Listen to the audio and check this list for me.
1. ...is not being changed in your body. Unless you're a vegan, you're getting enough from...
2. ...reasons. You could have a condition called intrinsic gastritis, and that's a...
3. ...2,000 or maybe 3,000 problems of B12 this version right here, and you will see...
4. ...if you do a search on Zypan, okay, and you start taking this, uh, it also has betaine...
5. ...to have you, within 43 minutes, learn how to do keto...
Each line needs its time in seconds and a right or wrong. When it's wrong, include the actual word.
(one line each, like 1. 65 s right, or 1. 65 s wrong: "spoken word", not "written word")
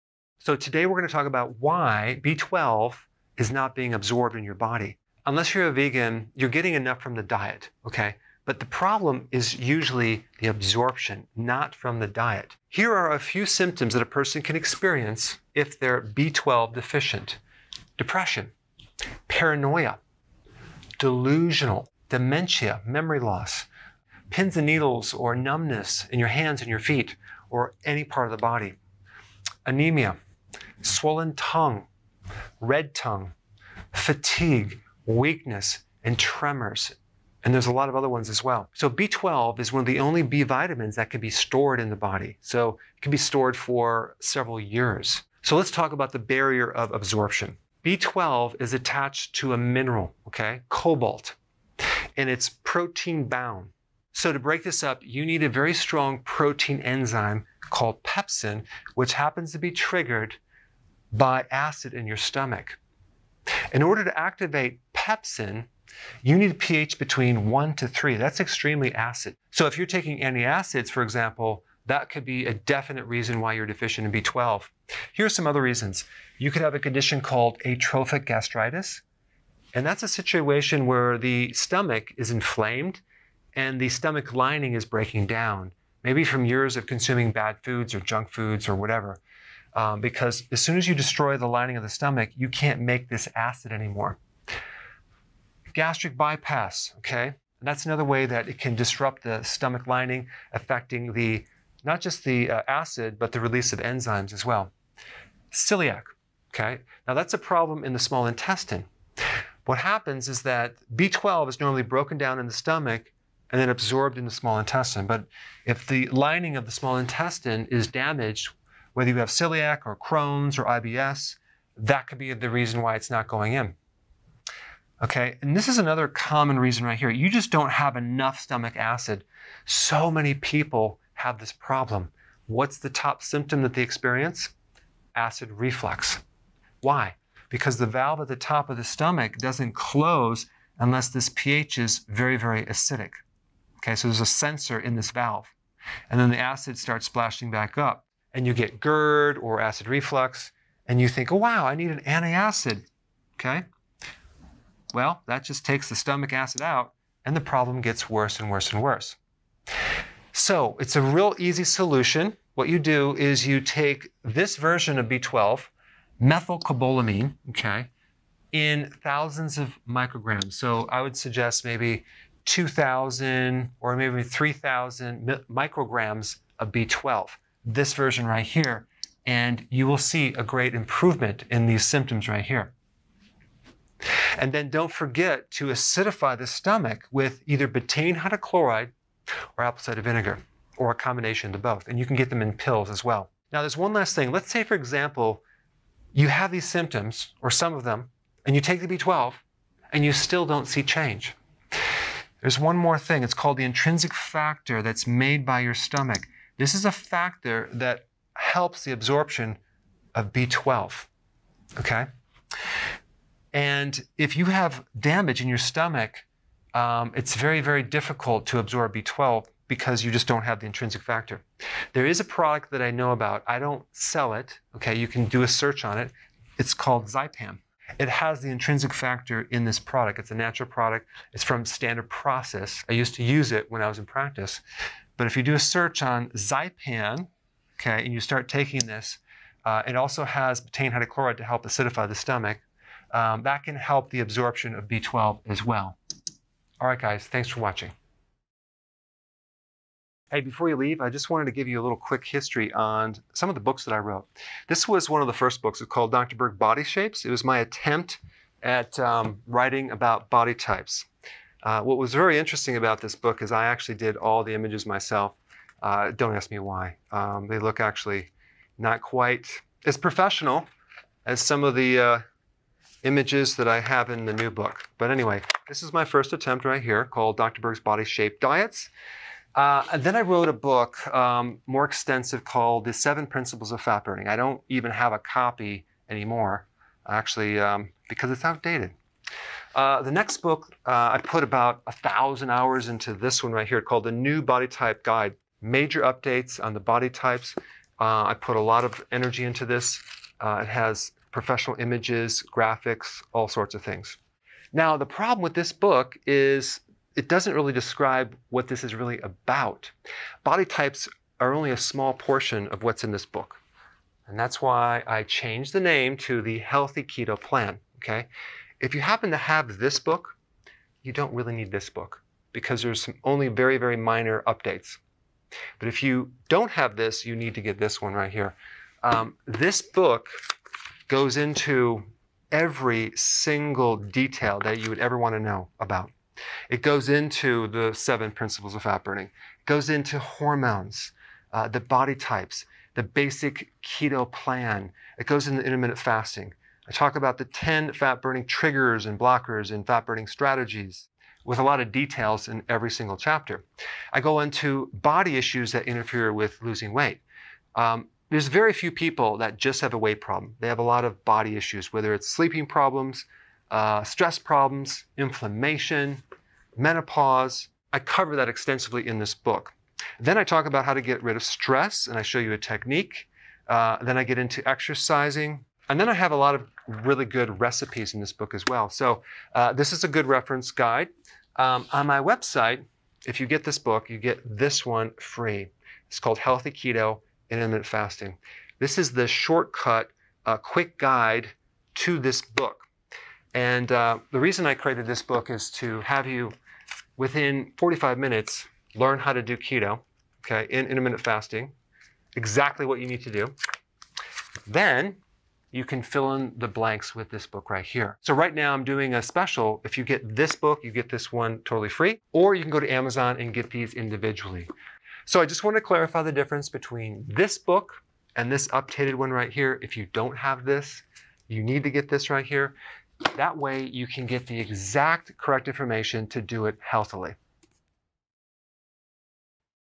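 1. 3 s wrong: "absorbed", not "changed"
2. 75 s wrong: "atrophic", not "intrinsic"
3. 172 s wrong: "micrograms", not "problems"
4. 235 s right
5. 395 s wrong: "45", not "43".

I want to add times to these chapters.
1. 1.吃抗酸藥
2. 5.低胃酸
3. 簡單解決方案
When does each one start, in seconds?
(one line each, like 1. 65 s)
1. 70 s
2. 126 s
3. 160 s.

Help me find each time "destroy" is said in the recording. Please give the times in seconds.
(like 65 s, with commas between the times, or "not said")
90 s.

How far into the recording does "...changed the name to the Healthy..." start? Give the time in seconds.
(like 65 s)
315 s.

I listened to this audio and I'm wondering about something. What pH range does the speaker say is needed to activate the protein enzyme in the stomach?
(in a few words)
1 to 3.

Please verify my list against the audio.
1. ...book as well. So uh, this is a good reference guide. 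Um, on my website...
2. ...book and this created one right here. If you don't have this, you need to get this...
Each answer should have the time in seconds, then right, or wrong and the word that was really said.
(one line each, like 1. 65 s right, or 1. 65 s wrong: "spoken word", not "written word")
1. 378 s right
2. 417 s wrong: "updated", not "created".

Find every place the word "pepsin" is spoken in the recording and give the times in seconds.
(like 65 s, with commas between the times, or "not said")
58 s, 64 s.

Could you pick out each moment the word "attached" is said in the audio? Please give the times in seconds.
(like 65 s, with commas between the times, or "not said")
48 s.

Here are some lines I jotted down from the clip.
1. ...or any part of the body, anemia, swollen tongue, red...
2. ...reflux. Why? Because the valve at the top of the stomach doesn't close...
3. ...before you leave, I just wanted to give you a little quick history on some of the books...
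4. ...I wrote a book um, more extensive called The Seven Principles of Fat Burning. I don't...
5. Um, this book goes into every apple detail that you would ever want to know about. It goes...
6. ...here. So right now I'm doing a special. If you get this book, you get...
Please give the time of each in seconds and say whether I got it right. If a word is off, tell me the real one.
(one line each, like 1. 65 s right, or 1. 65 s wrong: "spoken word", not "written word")
1. 27 s right
2. 135 s right
3. 250 s right
4. 280 s right
5. 329 s wrong: "single", not "apple"
6. 407 s right.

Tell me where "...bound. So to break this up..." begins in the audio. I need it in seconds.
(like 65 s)
53 s.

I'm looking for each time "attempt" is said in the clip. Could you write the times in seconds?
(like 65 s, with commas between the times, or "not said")
257 s, 276 s.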